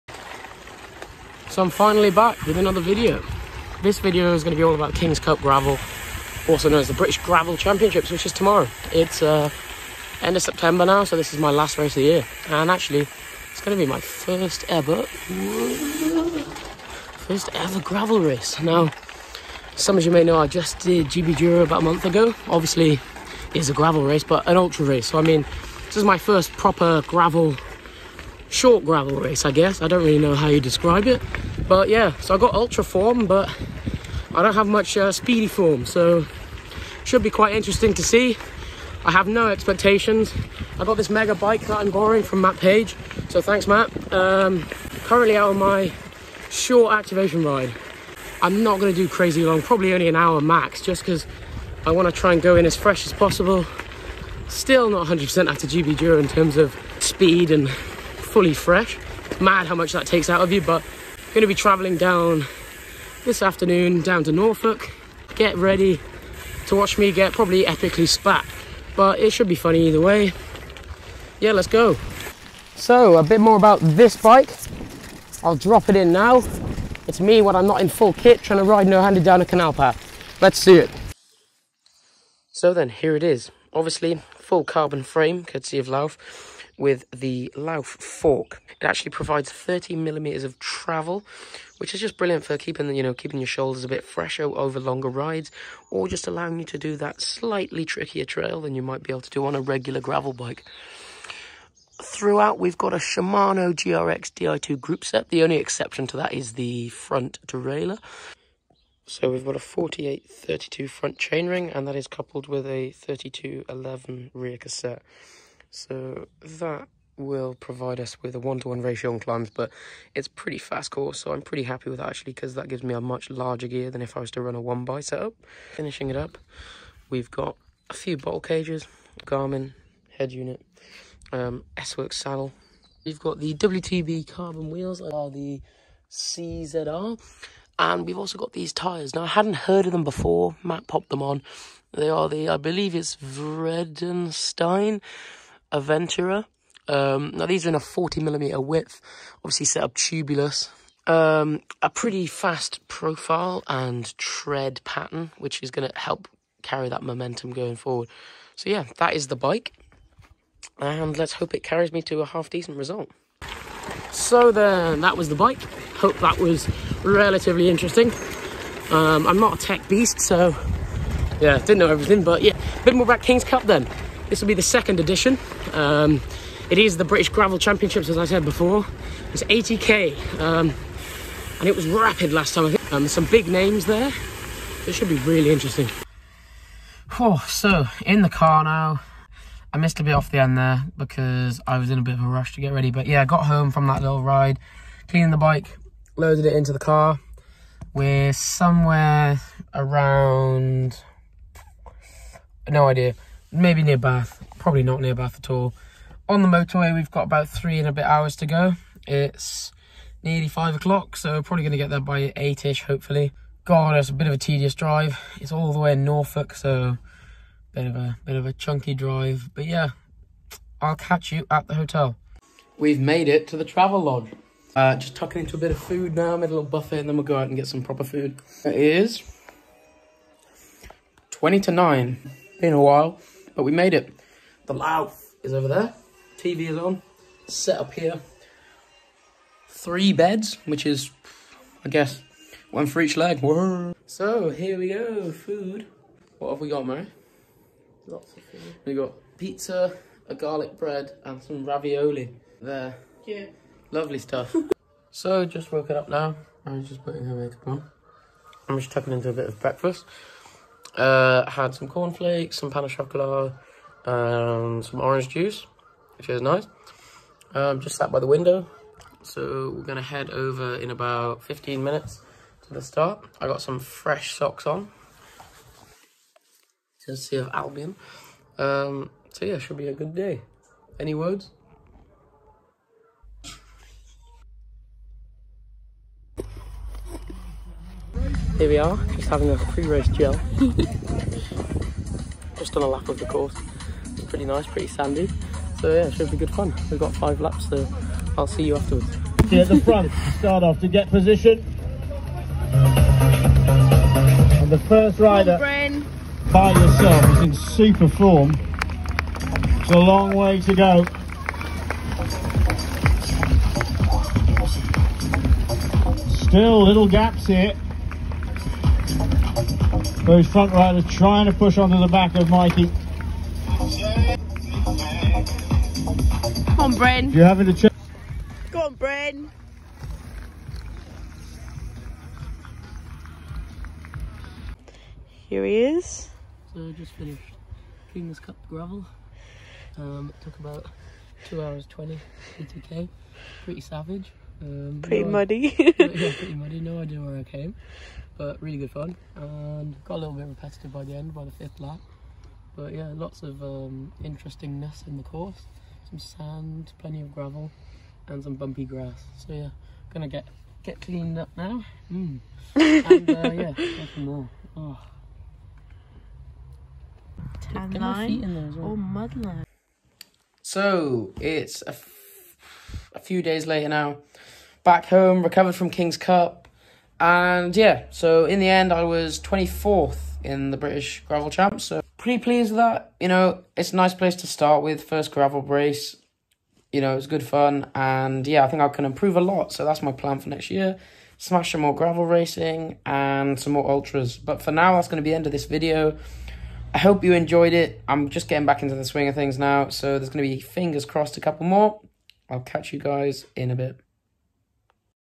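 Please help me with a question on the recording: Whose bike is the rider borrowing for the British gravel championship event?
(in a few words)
Matt Page.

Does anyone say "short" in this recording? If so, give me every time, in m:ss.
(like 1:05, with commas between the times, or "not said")
0:28, 0:46.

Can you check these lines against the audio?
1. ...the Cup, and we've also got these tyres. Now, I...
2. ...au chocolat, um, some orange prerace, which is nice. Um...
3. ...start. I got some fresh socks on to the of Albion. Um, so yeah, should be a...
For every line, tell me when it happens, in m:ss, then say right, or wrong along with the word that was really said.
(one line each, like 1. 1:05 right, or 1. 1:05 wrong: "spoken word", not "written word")
1. 2:15 wrong: "CZR", not "Cup"
2. 4:22 wrong: "juice", not "prerace"
3. 4:32 right.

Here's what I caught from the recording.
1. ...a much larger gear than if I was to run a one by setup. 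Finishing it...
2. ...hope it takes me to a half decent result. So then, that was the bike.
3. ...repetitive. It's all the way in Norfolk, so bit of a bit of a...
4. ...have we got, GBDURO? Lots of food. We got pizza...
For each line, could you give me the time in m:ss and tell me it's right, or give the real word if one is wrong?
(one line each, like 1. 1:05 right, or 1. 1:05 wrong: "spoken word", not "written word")
1. 2:02 right
2. 2:41 wrong: "carries", not "takes"
3. 3:34 wrong: "drive", not "repetitive"
4. 4:06 wrong: "Mary", not "GBDURO".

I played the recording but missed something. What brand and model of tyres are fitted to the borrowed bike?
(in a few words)
Vredestein Aventura.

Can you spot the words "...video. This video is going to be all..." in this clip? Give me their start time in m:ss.
0:02.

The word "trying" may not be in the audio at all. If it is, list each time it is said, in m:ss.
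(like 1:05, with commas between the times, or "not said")
1:18, 5:21.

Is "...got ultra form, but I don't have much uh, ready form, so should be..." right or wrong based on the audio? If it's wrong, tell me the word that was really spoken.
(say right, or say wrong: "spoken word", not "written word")
wrong: "speedy", not "ready".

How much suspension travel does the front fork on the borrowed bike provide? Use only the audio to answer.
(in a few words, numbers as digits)
30 millimeters.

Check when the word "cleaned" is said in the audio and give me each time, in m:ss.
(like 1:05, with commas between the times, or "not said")
3:15, 6:01.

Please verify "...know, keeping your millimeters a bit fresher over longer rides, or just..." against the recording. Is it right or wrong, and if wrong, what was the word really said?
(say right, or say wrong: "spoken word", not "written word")
wrong: "shoulders", not "millimeters".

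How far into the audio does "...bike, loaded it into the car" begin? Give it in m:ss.
3:15.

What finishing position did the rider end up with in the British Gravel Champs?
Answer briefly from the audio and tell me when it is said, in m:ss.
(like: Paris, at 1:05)
24th, at 6:19.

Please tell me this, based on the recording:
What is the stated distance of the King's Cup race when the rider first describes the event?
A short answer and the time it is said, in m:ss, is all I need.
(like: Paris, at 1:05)
80k, at 2:59.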